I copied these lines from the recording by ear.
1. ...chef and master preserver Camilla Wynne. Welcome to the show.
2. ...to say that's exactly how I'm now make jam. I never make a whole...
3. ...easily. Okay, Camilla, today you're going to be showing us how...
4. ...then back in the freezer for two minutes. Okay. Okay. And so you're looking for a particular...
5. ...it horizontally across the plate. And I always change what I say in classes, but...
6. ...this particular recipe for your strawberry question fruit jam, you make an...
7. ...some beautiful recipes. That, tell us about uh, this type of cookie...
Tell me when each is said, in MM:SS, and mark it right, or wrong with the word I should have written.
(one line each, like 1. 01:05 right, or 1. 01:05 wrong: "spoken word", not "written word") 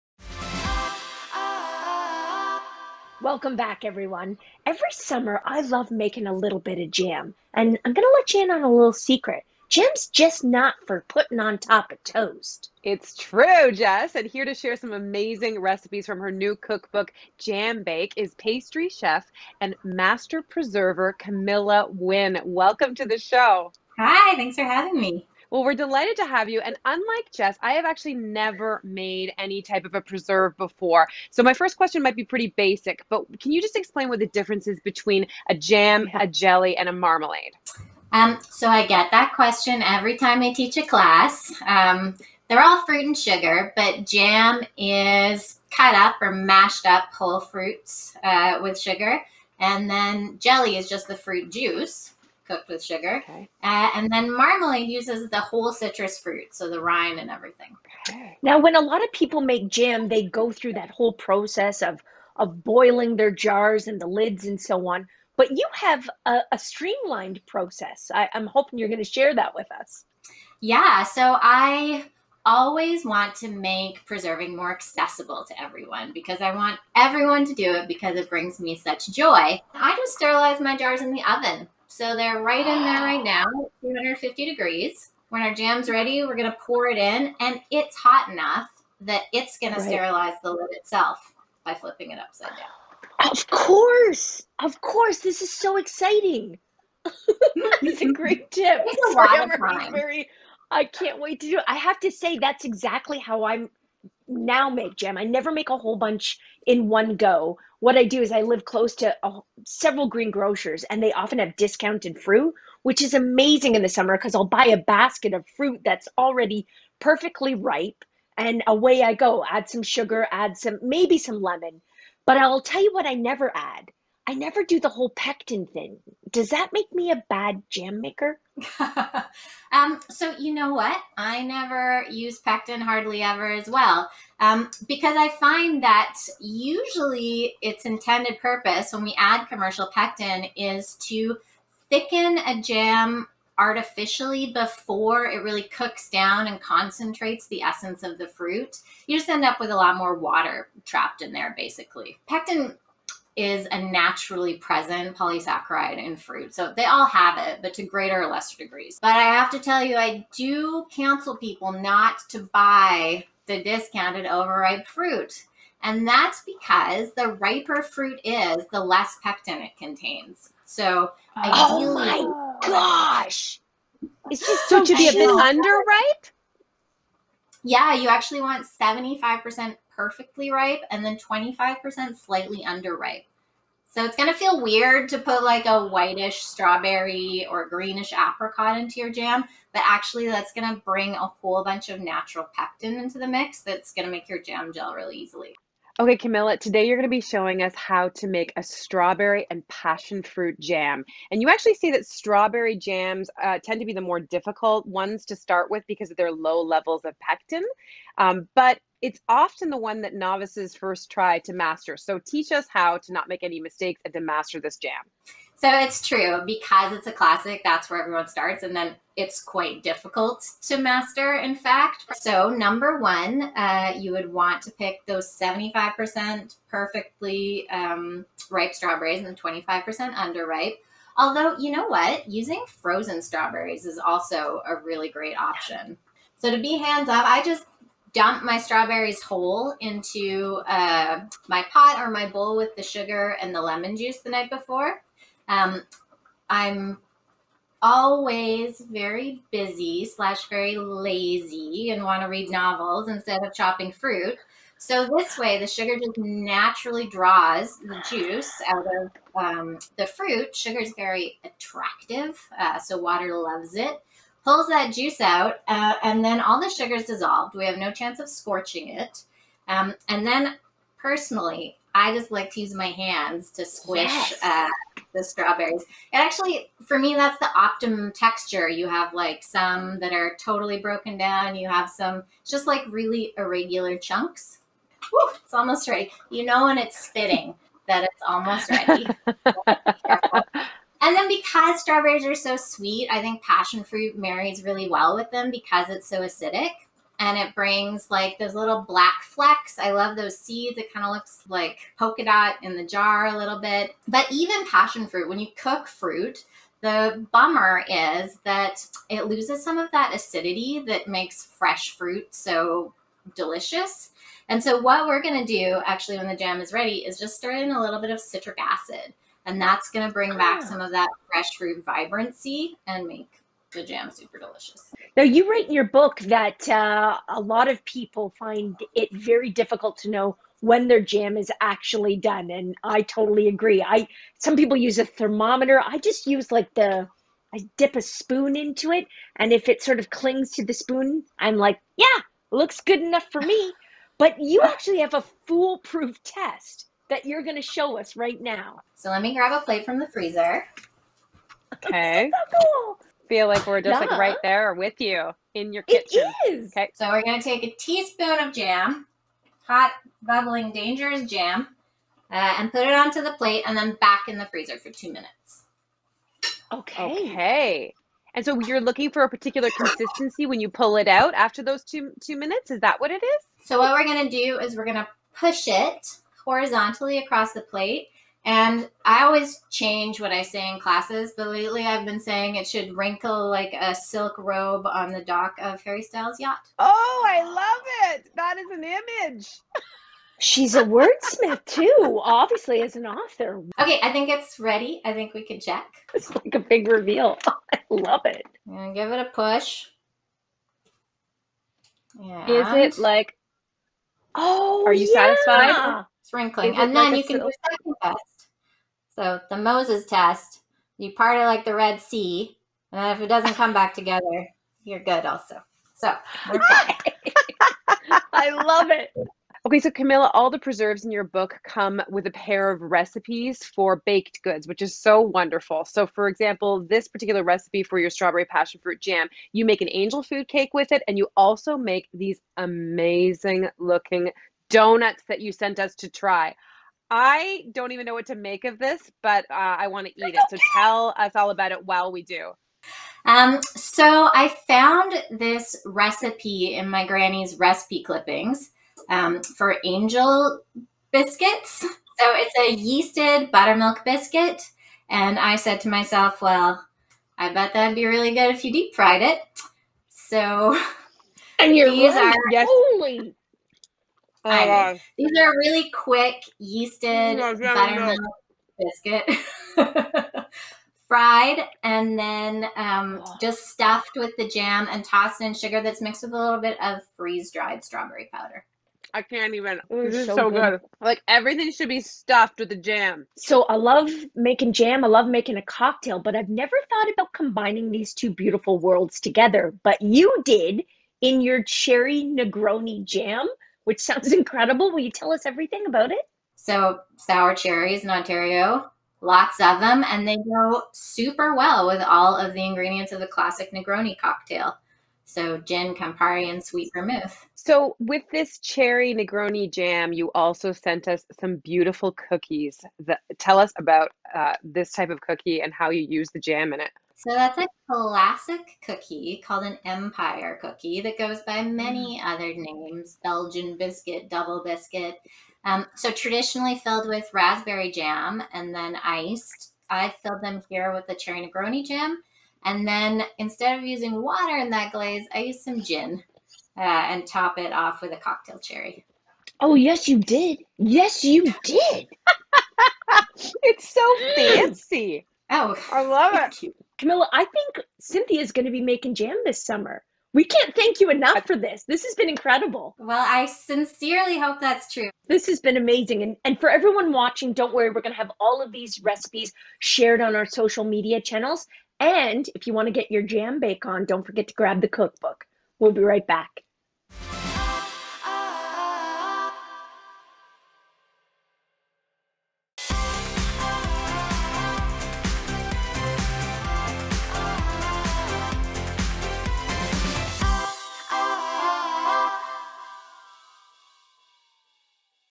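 1. 00:18 right
2. 01:42 right
3. 03:15 right
4. 06:03 right
5. 06:15 right
6. 07:06 wrong: "passion", not "question"
7. 08:31 wrong: "cookies", not "recipes".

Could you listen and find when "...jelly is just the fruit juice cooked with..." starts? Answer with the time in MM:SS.
00:50.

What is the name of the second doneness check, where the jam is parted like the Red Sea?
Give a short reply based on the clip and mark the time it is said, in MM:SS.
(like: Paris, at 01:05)
The Moses test, at 06:49.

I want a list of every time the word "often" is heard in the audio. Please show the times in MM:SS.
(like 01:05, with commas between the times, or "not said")
01:51, 03:29.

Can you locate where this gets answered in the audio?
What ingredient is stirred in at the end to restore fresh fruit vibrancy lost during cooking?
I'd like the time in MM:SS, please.
05:18.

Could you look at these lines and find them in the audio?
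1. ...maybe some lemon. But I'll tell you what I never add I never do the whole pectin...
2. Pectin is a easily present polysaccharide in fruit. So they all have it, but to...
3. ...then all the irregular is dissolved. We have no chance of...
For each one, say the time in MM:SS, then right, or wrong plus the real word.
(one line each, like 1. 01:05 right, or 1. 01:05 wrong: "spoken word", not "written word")
1. 02:00 right
2. 02:32 wrong: "naturally", not "easily"
3. 04:26 wrong: "sugar", not "irregular".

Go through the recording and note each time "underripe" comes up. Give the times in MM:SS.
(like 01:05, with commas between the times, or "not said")
02:55, 03:02, 03:50.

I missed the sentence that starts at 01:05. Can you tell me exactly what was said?
But you have a, a streamlined process.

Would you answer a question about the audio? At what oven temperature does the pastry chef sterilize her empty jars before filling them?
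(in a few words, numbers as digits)
250 degrees.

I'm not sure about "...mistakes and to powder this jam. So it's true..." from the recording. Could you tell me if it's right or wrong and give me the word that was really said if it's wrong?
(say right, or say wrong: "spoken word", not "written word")
wrong: "master", not "powder".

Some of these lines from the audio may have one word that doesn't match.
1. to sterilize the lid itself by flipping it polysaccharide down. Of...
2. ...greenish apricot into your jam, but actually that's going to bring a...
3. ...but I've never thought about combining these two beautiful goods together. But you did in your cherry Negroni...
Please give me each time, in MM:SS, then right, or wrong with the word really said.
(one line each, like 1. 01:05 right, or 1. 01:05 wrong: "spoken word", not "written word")
1. 01:29 wrong: "upside", not "polysaccharide"
2. 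03:07 right
3. 08:06 wrong: "worlds", not "goods".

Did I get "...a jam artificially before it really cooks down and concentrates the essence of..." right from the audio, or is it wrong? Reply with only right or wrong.
right.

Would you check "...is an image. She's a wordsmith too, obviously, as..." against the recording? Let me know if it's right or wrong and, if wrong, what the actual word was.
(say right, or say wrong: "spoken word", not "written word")
right.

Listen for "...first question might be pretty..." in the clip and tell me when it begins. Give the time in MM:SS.
00:31.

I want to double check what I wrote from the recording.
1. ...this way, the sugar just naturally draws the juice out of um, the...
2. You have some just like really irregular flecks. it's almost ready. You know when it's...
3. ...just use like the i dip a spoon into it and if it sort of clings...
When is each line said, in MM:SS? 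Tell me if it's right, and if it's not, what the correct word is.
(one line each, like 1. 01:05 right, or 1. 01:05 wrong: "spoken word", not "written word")
1. 04:15 right
2. 04:41 wrong: "chunks", not "flecks"
3. 05:35 right.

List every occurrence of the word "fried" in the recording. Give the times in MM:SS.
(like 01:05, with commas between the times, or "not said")
07:38, 07:51.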